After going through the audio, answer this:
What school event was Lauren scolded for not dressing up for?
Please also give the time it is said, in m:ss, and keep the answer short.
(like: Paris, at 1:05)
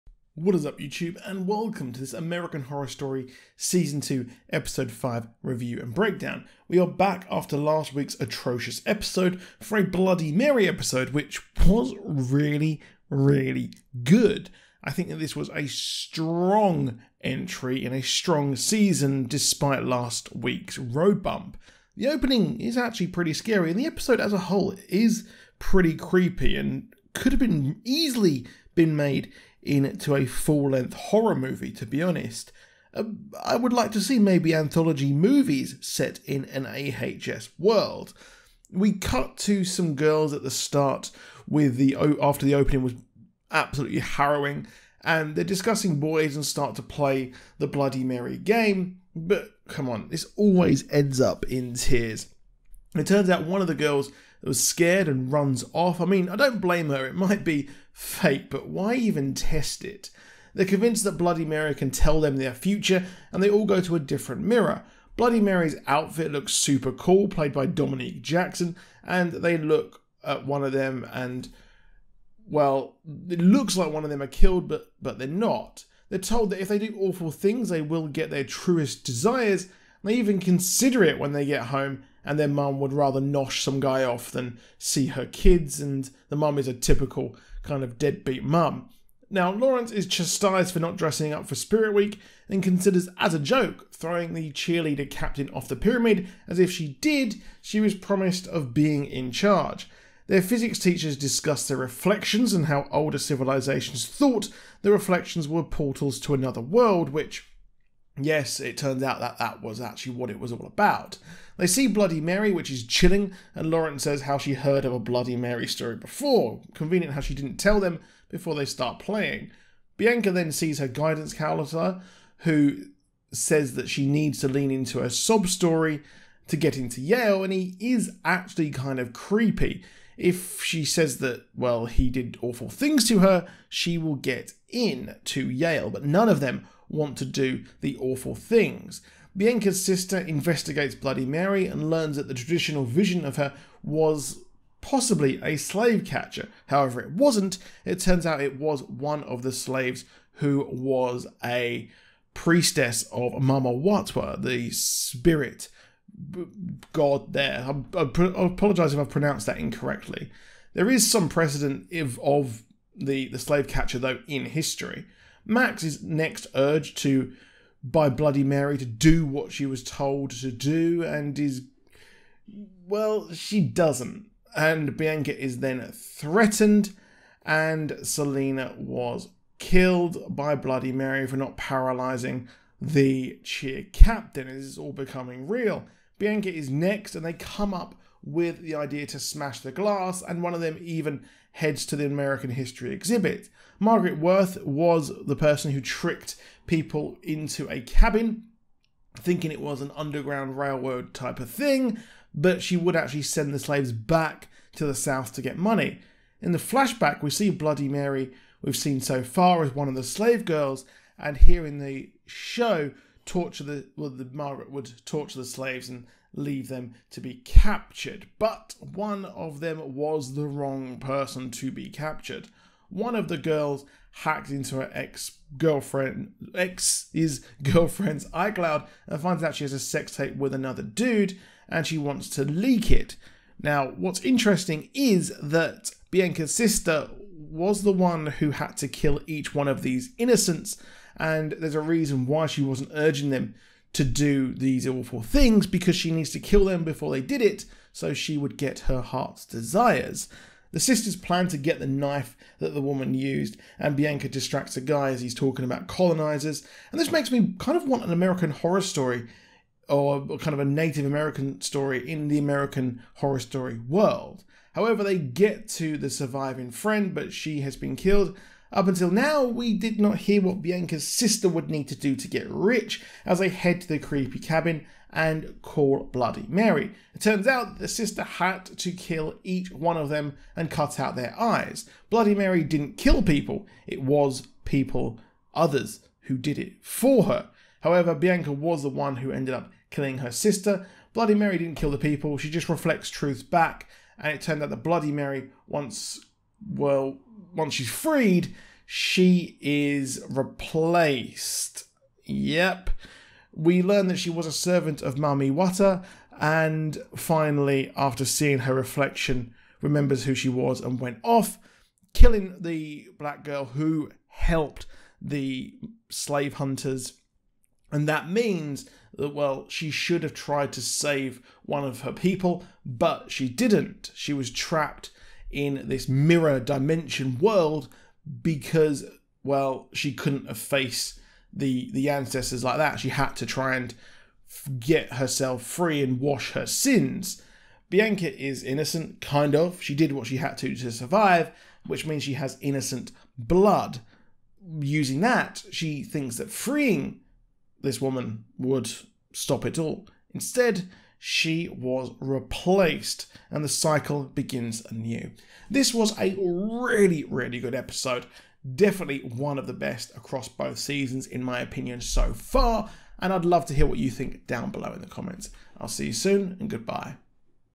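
Spirit Week, at 1:31.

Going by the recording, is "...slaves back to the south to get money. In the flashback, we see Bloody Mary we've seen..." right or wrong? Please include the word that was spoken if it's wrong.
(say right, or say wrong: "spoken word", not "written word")
right.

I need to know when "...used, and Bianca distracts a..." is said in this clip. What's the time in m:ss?
4:13.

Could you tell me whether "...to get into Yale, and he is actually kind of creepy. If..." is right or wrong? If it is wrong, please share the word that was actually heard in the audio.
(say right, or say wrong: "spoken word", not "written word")
right.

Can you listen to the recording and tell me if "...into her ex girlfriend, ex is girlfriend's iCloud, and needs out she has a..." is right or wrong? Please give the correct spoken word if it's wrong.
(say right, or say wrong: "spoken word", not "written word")
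wrong: "finds", not "needs".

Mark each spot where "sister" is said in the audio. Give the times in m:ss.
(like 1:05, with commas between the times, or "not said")
2:19, 3:56, 4:10, 4:31, 4:37, 4:50.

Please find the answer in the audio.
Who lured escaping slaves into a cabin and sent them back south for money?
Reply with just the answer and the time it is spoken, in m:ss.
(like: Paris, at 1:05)
Margaret Worth, at 3:13.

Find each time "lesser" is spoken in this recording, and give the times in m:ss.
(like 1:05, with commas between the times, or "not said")
not said.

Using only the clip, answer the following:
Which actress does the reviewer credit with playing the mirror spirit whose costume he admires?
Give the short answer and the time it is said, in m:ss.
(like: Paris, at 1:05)
Dominique Jackson, at 1:07.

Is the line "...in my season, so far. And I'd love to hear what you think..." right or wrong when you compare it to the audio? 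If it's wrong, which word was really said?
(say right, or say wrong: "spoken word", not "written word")
wrong: "opinion", not "season".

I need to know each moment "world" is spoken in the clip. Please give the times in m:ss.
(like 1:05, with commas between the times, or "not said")
0:37, 1:46, 4:23, 5:27.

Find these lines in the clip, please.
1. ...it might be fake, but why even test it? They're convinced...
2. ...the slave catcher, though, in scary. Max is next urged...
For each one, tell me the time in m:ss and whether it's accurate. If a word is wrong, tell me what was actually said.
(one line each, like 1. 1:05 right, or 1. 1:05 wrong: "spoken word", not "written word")
1. 0:57 right
2. 2:43 wrong: "history", not "scary".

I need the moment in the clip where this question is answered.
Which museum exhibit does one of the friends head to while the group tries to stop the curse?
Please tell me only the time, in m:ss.
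3:12.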